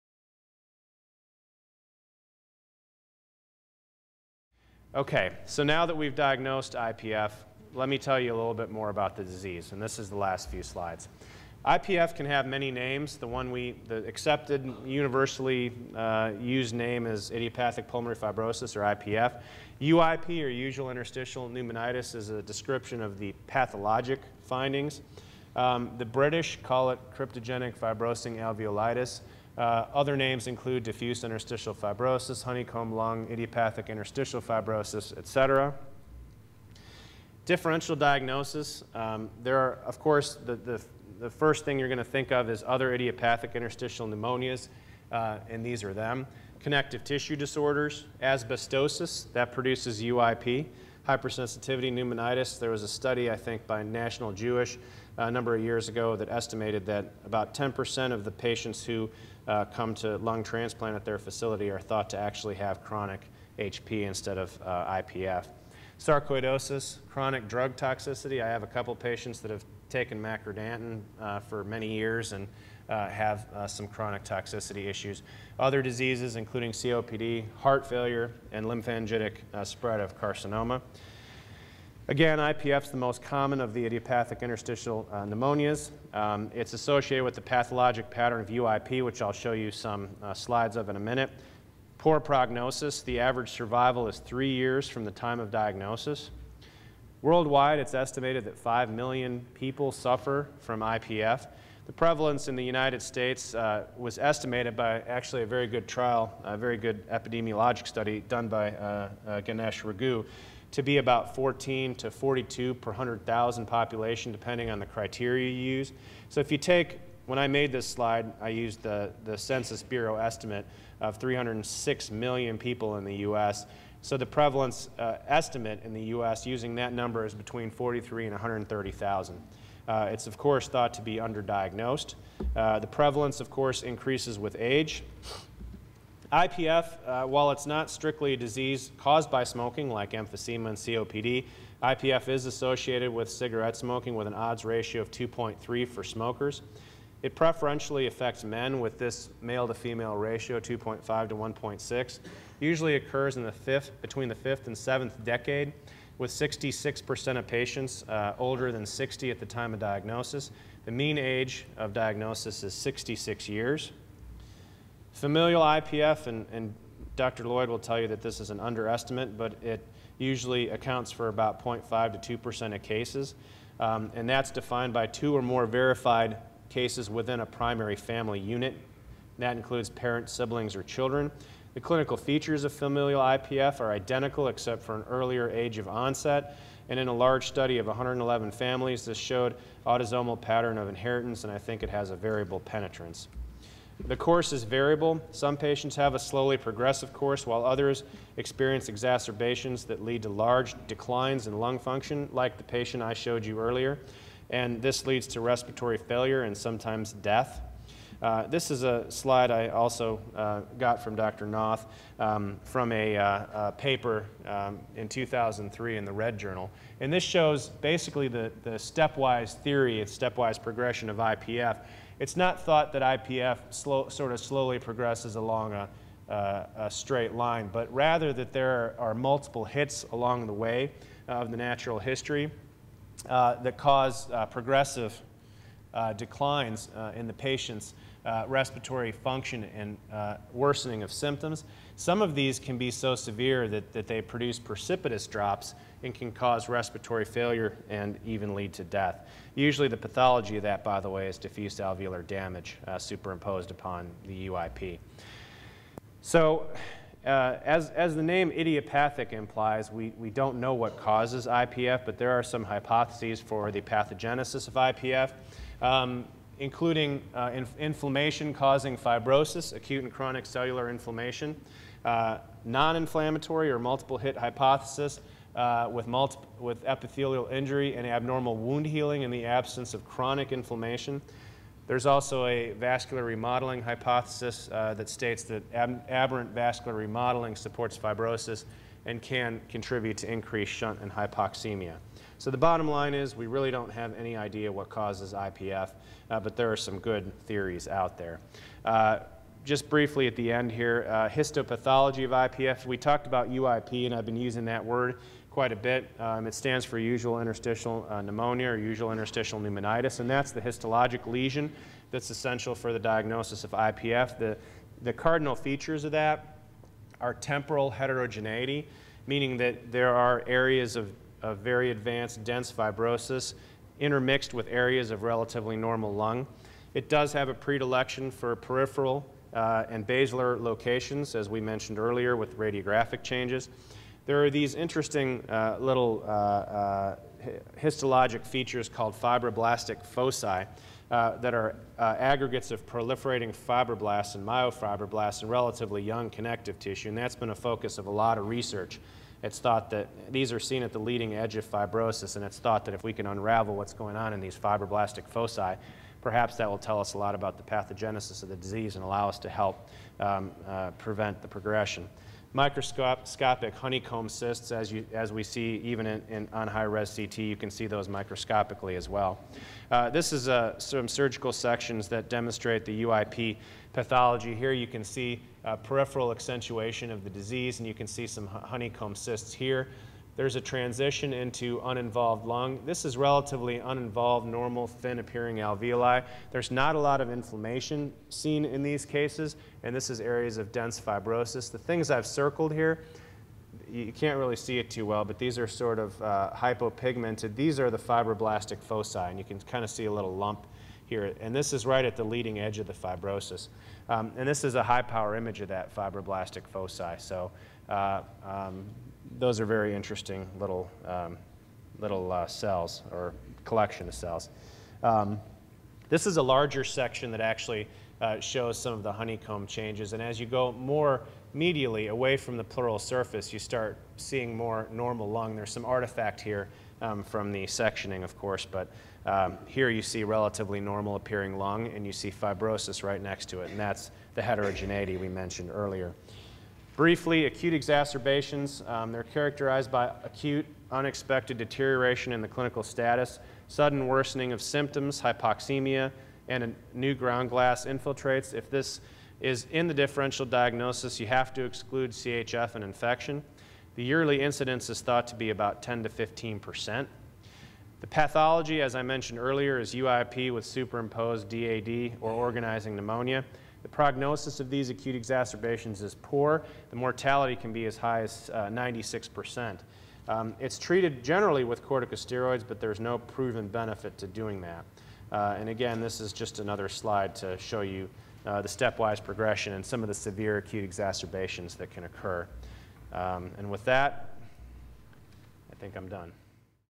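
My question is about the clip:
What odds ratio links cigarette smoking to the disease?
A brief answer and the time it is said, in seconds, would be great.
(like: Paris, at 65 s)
2.3, at 145 s.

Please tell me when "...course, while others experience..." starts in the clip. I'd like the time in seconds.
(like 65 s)
197 s.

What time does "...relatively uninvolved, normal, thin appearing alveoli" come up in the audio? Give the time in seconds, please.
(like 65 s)
383 s.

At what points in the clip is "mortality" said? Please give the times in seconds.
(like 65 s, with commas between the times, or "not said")
466 s.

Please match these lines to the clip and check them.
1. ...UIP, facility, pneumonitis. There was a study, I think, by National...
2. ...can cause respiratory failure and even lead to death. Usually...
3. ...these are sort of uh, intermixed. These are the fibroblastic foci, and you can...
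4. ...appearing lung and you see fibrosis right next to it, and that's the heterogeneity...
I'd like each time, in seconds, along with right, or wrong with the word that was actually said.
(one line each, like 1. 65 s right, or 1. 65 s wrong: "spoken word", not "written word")
1. 50 s wrong: "hypersensitivity", not "facility"
2. 246 s right
3. 395 s wrong: "hypopigmented", not "intermixed"
4. 431 s right.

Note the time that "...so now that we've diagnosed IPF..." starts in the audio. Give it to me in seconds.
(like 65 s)
5 s.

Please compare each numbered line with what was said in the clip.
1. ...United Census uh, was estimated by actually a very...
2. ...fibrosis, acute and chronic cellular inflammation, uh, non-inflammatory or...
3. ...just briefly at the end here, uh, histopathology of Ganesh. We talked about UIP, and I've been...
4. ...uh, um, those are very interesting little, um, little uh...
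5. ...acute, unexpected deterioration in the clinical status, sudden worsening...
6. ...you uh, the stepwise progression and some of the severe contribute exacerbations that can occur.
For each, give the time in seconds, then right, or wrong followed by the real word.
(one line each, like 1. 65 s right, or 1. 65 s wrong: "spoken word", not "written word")
1. 102 s wrong: "States", not "Census"
2. 268 s right
3. 299 s wrong: "IPF", not "Ganesh"
4. 407 s right
5. 440 s right
6. 477 s wrong: "acute", not "contribute".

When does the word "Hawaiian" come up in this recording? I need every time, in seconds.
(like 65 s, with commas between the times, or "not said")
not said.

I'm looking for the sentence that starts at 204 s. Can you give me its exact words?
And this leads to respiratory failure and sometimes death.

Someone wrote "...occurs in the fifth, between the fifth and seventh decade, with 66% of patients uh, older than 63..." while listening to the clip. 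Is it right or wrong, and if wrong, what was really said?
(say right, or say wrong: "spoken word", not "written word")
wrong: "60", not "63".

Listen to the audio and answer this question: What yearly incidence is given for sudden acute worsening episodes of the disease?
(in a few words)
10 to 15 percent.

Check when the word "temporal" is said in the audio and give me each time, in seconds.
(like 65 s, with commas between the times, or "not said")
317 s.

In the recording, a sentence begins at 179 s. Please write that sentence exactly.
that includes parents, siblings, or children.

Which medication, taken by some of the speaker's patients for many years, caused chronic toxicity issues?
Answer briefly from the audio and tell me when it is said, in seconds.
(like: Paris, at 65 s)
Macrodantin, at 70 s.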